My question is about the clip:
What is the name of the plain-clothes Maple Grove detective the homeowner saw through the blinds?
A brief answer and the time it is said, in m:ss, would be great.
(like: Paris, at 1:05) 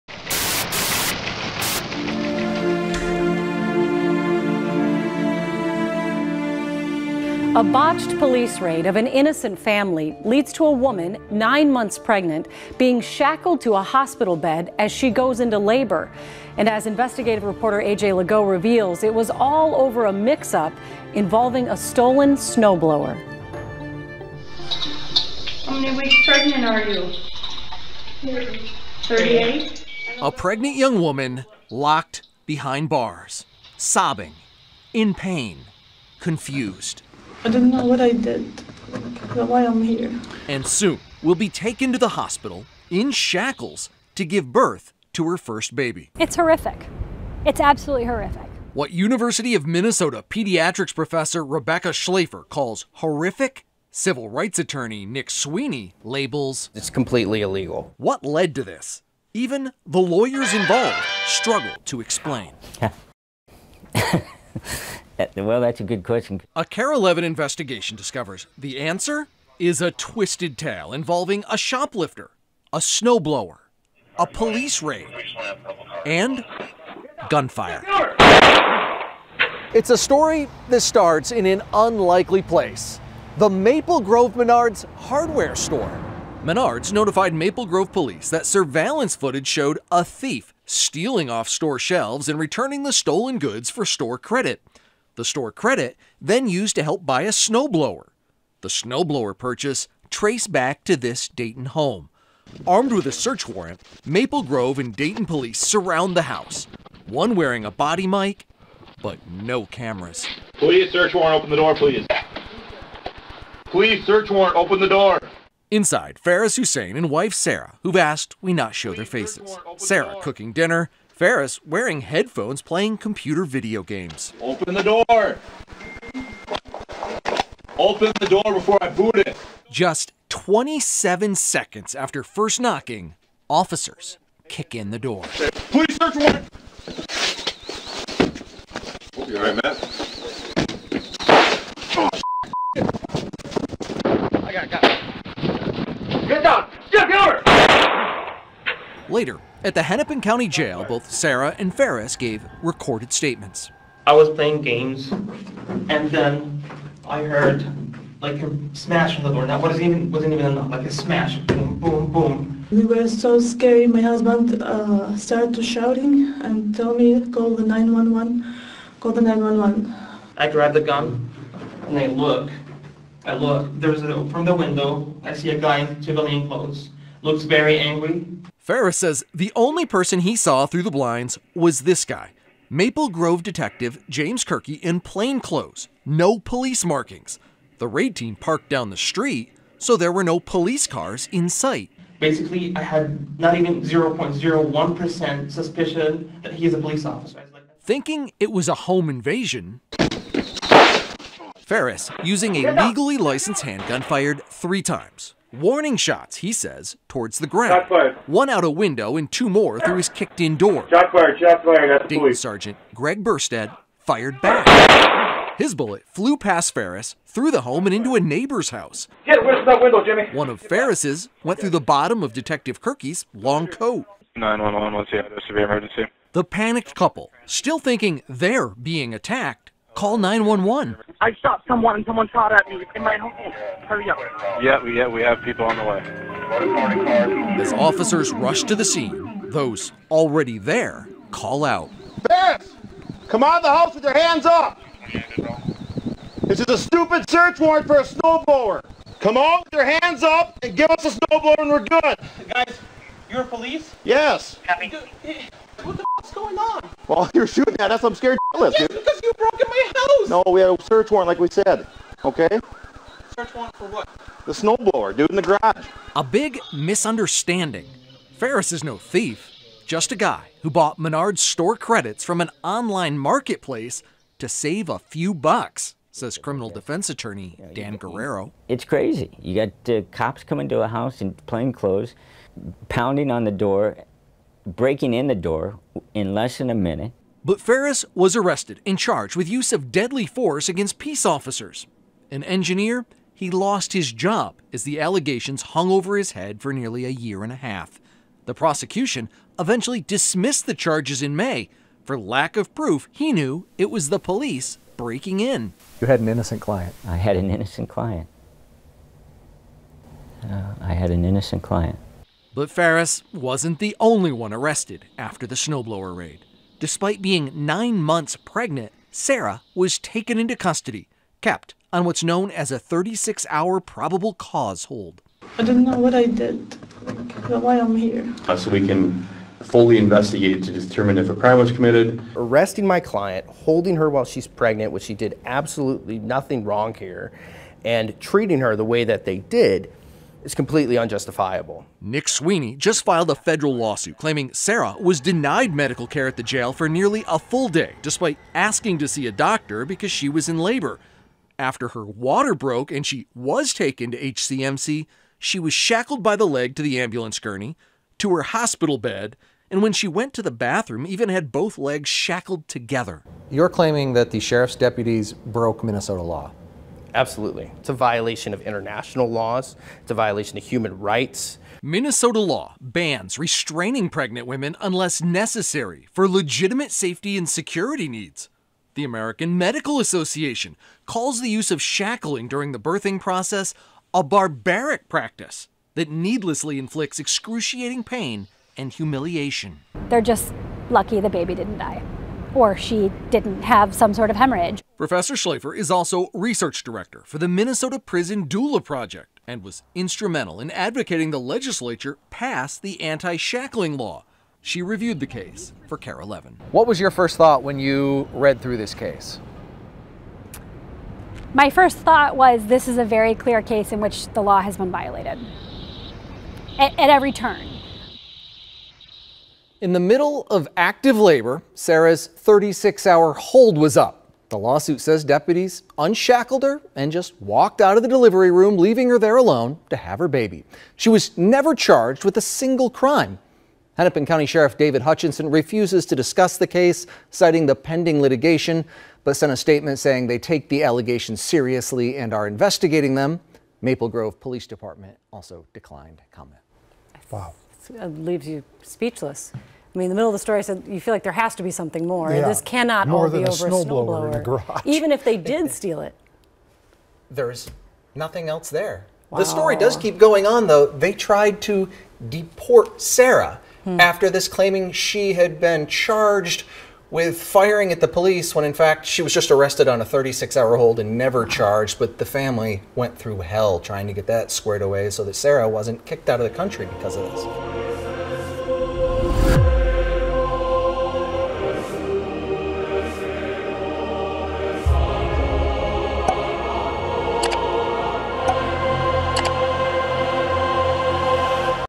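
James Kirky, at 3:04.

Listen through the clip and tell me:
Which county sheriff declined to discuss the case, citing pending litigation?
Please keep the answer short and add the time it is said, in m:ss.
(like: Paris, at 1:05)
David Hutchinson, at 7:14.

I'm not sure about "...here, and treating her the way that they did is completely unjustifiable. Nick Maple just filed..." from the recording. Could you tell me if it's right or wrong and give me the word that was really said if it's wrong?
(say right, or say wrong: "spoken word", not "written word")
wrong: "Sweeney", not "Maple".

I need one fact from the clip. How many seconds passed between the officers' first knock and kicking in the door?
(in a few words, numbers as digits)
27.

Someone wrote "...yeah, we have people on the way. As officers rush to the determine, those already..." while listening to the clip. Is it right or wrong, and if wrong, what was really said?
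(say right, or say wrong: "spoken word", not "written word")
wrong: "scene", not "determine".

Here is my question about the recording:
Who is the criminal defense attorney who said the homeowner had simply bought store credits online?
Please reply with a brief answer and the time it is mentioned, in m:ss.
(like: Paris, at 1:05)
Dan Guerrero, at 4:37.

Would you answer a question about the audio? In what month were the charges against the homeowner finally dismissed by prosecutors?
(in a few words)
May.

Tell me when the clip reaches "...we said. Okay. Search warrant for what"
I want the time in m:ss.
4:21.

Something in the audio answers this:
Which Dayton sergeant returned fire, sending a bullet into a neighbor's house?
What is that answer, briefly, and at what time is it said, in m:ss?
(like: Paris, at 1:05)
Greg Burstead, at 3:32.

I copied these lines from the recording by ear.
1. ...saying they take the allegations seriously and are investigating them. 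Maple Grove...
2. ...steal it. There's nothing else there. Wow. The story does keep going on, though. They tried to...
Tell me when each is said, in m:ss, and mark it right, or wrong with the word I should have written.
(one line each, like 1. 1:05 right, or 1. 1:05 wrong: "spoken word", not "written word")
1. 7:19 right
2. 7:35 right.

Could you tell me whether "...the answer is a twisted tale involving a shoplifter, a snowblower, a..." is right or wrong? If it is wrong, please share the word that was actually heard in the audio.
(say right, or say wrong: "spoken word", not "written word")
right.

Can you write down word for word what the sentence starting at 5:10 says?
Uh, I had an innocent client.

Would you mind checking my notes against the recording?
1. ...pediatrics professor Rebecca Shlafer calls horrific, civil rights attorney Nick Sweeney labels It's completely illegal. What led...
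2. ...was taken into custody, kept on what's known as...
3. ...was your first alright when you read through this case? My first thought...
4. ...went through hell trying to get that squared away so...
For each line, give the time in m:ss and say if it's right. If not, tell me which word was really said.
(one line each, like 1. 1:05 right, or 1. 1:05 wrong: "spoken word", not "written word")
1. 0:50 right
2. 5:19 right
3. 6:46 wrong: "thought", not "alright"
4. 7:52 right.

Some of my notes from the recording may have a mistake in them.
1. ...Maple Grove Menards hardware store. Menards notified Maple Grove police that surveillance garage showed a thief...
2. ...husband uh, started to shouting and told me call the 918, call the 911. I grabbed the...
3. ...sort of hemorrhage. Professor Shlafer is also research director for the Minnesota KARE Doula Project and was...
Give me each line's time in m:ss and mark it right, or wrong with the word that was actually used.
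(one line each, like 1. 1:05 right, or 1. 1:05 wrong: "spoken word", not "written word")
1. 1:23 wrong: "footage", not "garage"
2. 2:44 wrong: "911", not "918"
3. 6:34 wrong: "Prison", not "KARE".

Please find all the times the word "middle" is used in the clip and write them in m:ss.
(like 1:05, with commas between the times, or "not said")
6:59, 7:30.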